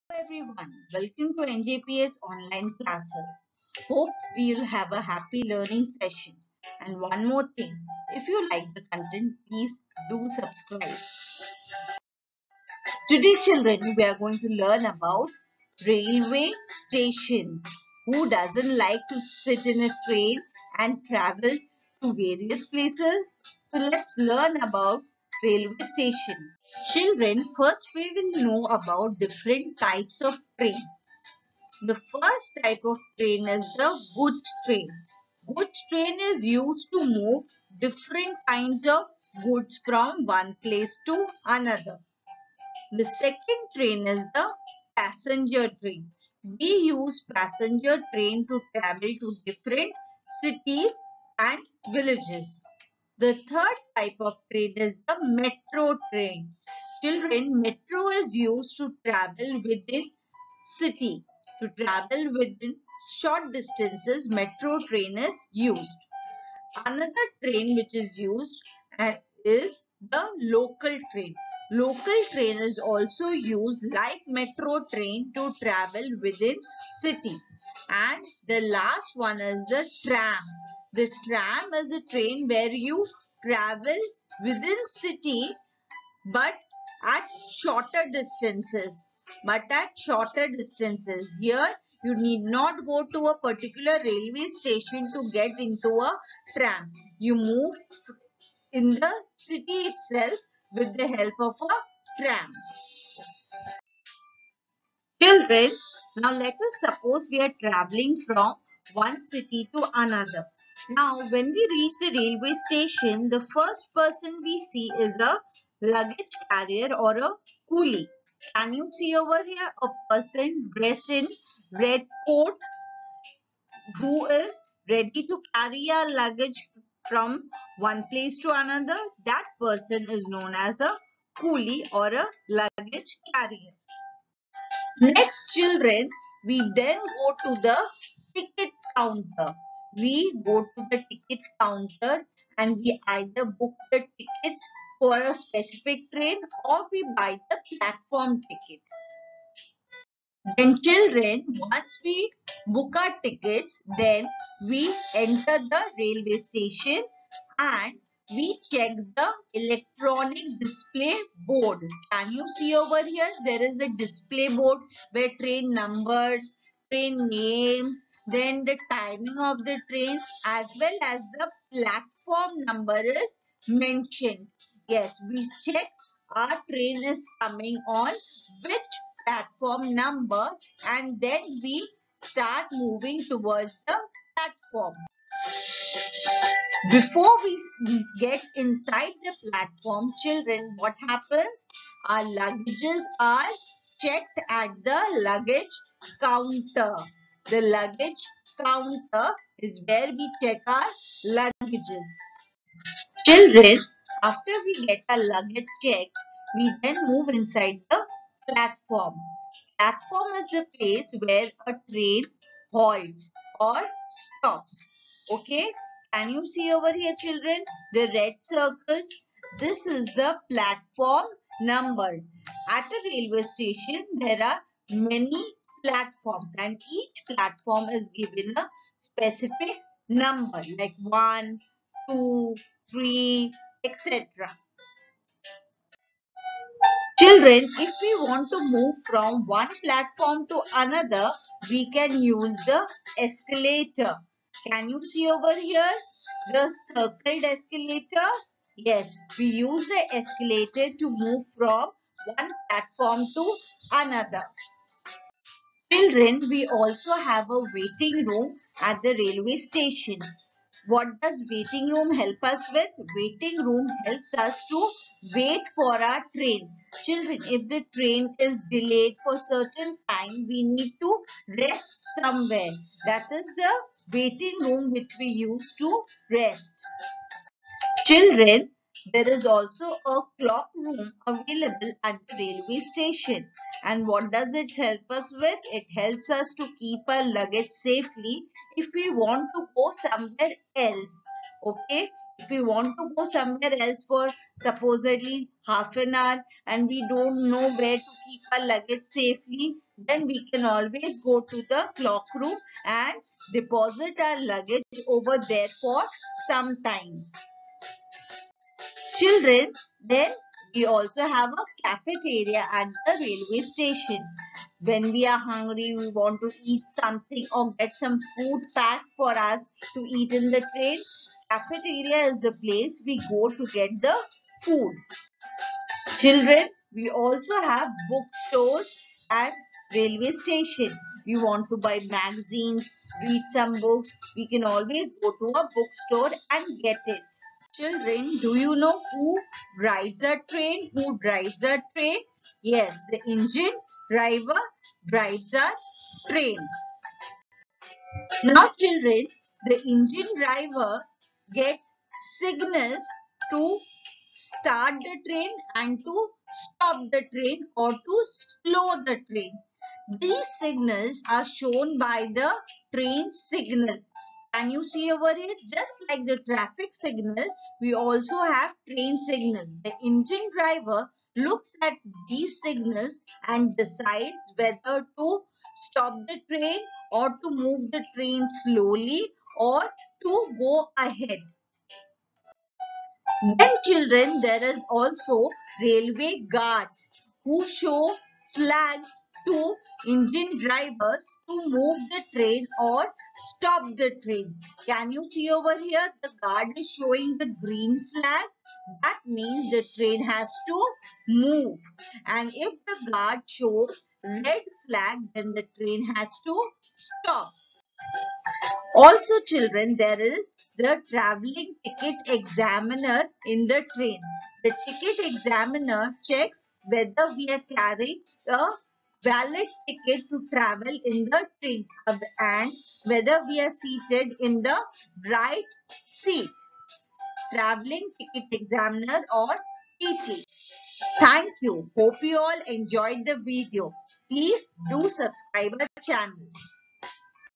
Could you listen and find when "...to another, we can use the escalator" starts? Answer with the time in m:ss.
4:00.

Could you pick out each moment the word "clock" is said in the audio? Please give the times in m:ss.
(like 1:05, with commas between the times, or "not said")
4:40, 5:01.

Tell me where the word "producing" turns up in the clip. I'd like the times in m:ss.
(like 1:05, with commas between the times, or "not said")
not said.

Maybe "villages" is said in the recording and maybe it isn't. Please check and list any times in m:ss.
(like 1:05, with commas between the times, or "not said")
0:51.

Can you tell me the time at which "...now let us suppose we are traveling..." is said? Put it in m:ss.
1:46.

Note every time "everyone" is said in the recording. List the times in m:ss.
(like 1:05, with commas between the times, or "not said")
0:00.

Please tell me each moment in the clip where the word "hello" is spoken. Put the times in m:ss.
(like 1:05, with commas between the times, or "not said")
not said.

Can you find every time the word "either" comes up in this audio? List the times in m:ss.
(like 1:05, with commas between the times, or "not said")
2:23.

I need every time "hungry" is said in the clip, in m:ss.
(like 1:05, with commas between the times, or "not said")
5:15.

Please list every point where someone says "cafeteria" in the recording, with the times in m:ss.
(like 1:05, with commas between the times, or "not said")
5:11, 5:21.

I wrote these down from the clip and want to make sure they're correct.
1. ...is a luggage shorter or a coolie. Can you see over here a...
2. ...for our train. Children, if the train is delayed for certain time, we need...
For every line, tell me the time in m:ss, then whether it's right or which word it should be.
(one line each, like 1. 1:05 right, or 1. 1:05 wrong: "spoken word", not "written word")
1. 1:54 wrong: "carrier", not "shorter"
2. 4:25 right.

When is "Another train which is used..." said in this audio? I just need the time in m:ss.
1:06.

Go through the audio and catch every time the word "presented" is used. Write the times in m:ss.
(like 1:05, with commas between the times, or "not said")
not said.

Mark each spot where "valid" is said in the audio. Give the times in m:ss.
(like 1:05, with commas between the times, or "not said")
6:59.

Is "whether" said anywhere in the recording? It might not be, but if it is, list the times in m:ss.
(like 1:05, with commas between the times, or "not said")
6:14, 6:56, 7:03.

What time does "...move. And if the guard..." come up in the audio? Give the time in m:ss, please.
6:41.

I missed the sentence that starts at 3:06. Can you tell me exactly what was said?
Before we get inside the platform, children, what happens?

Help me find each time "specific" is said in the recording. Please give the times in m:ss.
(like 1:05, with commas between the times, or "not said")
2:25, 3:48.